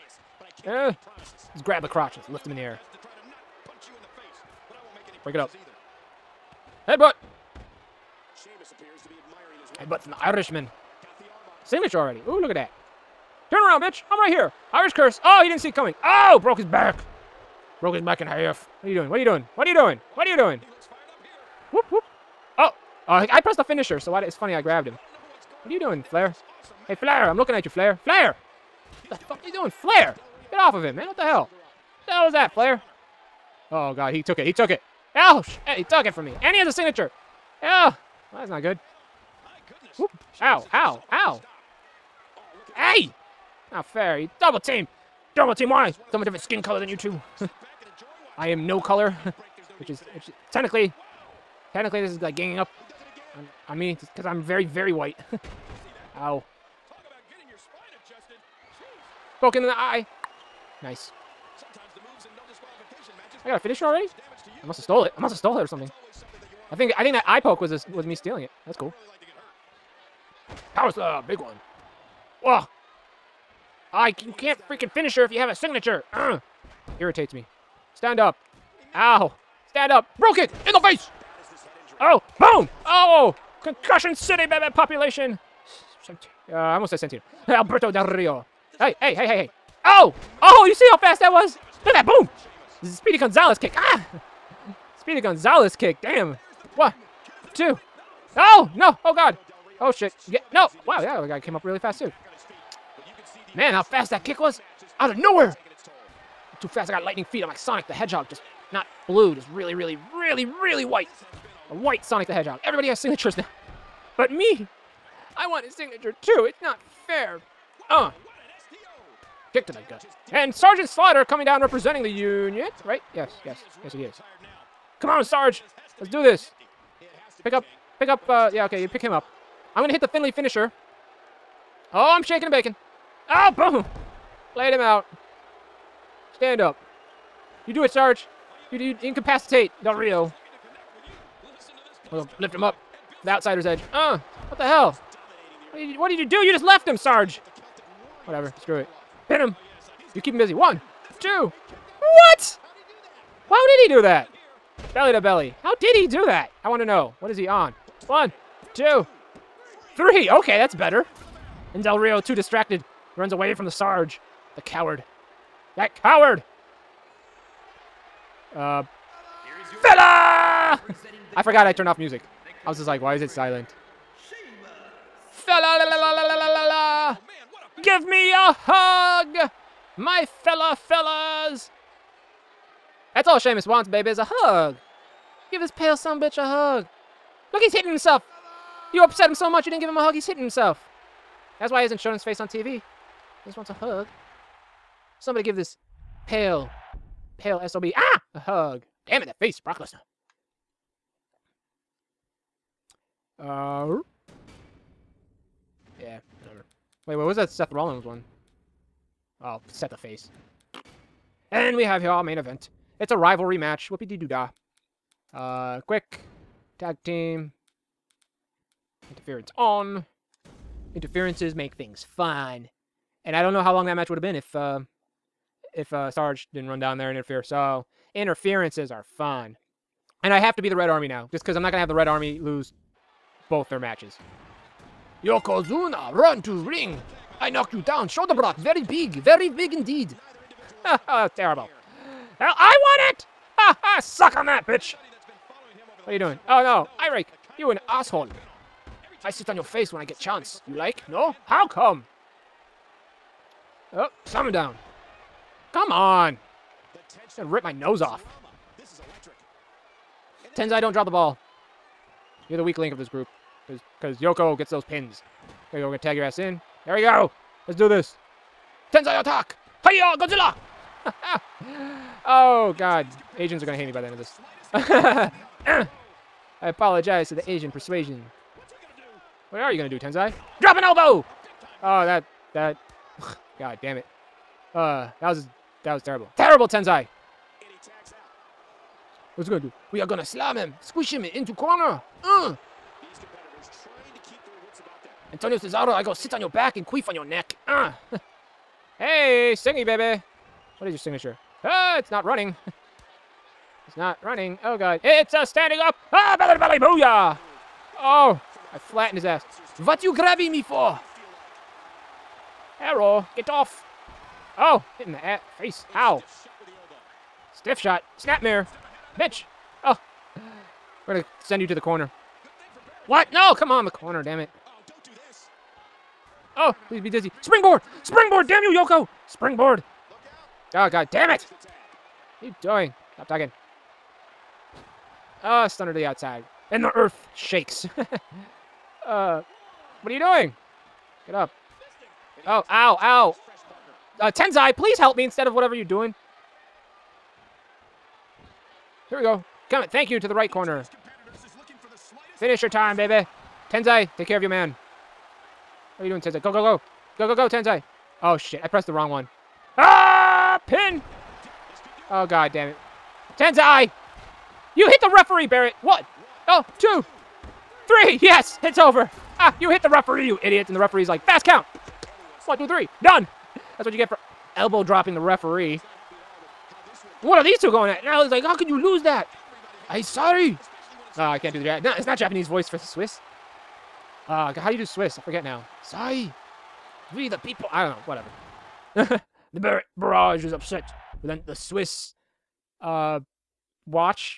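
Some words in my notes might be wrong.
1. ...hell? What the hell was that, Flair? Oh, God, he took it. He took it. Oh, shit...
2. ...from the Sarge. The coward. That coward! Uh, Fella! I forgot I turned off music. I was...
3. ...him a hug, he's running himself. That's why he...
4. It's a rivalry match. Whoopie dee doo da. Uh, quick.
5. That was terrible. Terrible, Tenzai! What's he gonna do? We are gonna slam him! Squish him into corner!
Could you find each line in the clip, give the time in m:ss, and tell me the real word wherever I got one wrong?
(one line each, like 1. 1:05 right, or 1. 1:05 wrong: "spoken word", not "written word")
1. 0:31 right
2. 2:43 right
3. 3:09 wrong: "hitting", not "running"
4. 3:32 right
5. 4:45 right.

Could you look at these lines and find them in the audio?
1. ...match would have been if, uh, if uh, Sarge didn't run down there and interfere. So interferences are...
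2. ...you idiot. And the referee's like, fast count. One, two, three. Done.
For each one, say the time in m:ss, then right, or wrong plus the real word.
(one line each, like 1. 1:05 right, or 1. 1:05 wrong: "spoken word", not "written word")
1. 3:43 right
2. 6:10 right.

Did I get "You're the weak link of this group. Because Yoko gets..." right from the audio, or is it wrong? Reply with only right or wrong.
right.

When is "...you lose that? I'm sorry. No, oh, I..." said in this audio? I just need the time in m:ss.
6:18.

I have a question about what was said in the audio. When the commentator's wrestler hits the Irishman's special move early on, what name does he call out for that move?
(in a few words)
Irish curse.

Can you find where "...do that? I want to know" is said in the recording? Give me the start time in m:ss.
2:36.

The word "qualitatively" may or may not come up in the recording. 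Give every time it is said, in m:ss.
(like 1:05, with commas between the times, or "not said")
not said.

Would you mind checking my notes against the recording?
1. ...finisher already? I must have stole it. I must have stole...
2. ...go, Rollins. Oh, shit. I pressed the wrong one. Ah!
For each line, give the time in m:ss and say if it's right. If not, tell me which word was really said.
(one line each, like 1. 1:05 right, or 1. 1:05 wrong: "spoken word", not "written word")
1. 1:03 right
2. 5:57 wrong: "Tenzai", not "Rollins".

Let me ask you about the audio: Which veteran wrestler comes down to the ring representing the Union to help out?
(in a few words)
Sergeant Slaughter.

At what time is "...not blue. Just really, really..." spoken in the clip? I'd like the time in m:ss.
1:48.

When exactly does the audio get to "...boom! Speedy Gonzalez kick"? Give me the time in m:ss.
1:32.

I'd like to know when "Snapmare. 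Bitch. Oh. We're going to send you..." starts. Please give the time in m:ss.
5:18.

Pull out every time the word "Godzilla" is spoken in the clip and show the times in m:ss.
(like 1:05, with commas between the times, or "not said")
4:30.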